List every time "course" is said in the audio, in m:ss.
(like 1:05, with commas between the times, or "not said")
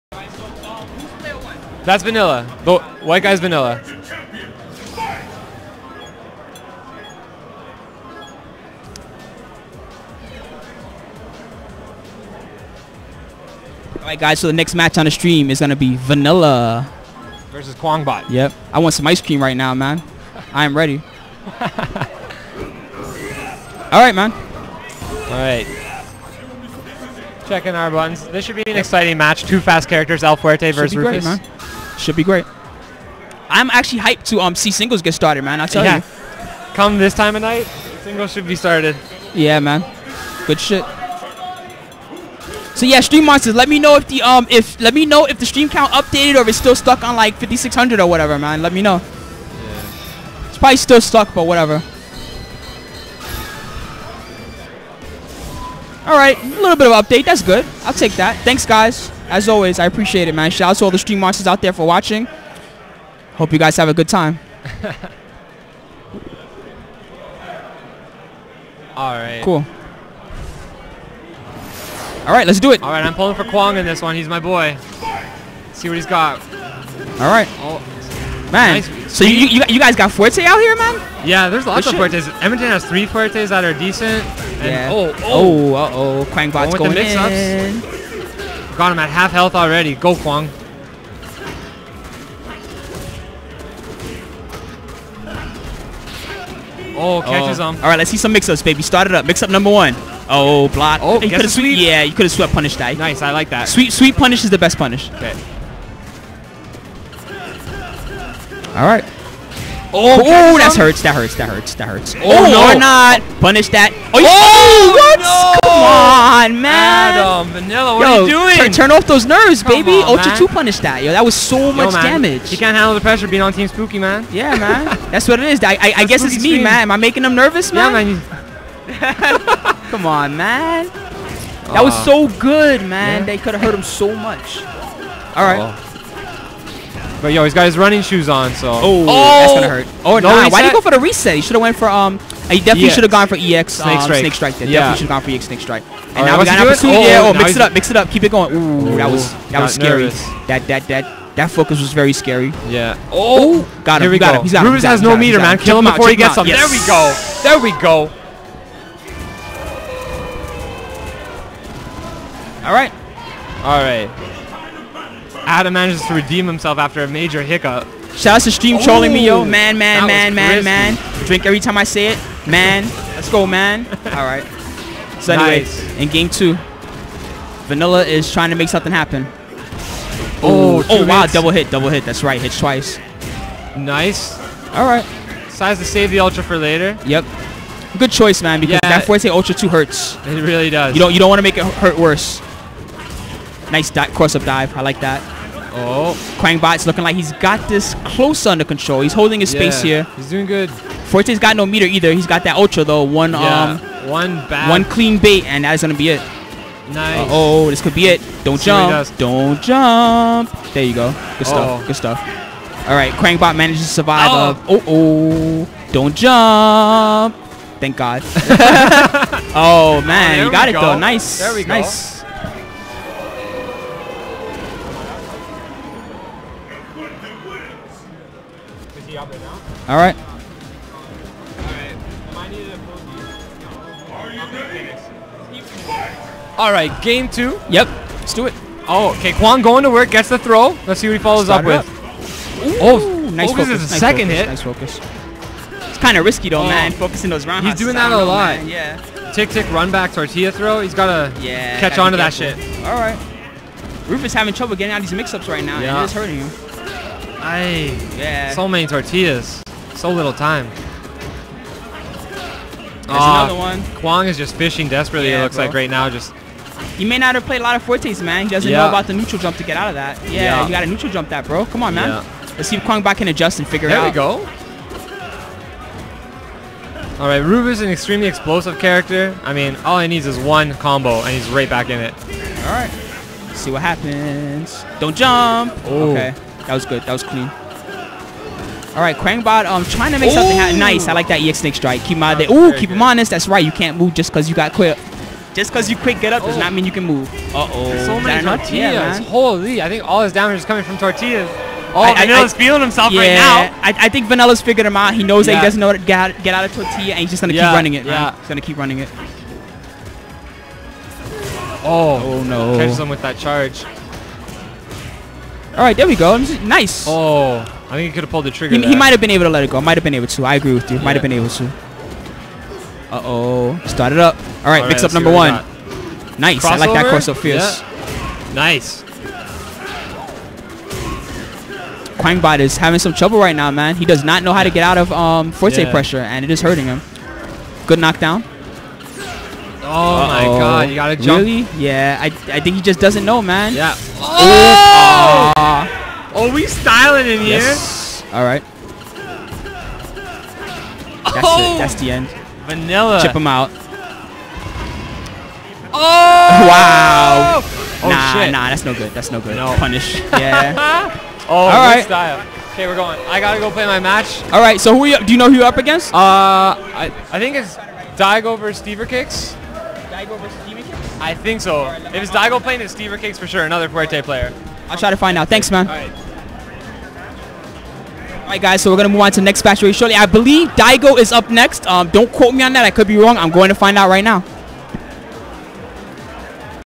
5:27.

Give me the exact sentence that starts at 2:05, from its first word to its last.
I, I, I guess it's me, stream.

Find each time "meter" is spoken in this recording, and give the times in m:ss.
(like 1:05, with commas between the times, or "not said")
2:35, 3:21.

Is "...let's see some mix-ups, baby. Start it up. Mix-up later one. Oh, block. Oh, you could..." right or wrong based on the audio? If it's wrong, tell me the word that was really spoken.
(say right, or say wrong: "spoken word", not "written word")
wrong: "number", not "later".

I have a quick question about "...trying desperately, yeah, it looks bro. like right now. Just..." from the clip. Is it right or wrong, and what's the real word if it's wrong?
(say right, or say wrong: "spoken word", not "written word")
wrong: "fishing", not "trying".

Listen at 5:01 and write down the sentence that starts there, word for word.
Oh, I, Vanilla's I, feeling himself yeah, right now.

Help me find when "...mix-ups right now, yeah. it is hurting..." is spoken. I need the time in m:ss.
4:15.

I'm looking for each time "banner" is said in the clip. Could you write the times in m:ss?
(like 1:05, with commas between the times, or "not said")
not said.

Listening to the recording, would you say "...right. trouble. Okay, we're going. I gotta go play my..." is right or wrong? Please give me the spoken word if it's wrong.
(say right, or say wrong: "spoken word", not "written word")
wrong: "style", not "trouble".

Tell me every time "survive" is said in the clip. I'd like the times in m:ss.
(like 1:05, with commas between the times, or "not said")
3:33.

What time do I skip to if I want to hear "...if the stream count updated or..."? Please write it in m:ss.
0:45.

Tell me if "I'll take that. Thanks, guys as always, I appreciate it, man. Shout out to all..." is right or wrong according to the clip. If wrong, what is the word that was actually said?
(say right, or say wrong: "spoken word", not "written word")
right.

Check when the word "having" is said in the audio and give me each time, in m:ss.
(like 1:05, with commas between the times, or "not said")
4:14, 5:32.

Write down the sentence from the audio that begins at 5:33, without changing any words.
He does not know how to get out of um, Fuerte yeah.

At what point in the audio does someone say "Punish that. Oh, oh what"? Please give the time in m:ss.
1:53.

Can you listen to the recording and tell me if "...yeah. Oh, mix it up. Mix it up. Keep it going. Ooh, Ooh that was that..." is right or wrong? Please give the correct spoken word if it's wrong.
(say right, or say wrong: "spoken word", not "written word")
right.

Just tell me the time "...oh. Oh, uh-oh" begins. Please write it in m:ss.
1:25.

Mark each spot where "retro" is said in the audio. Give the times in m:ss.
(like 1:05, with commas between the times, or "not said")
not said.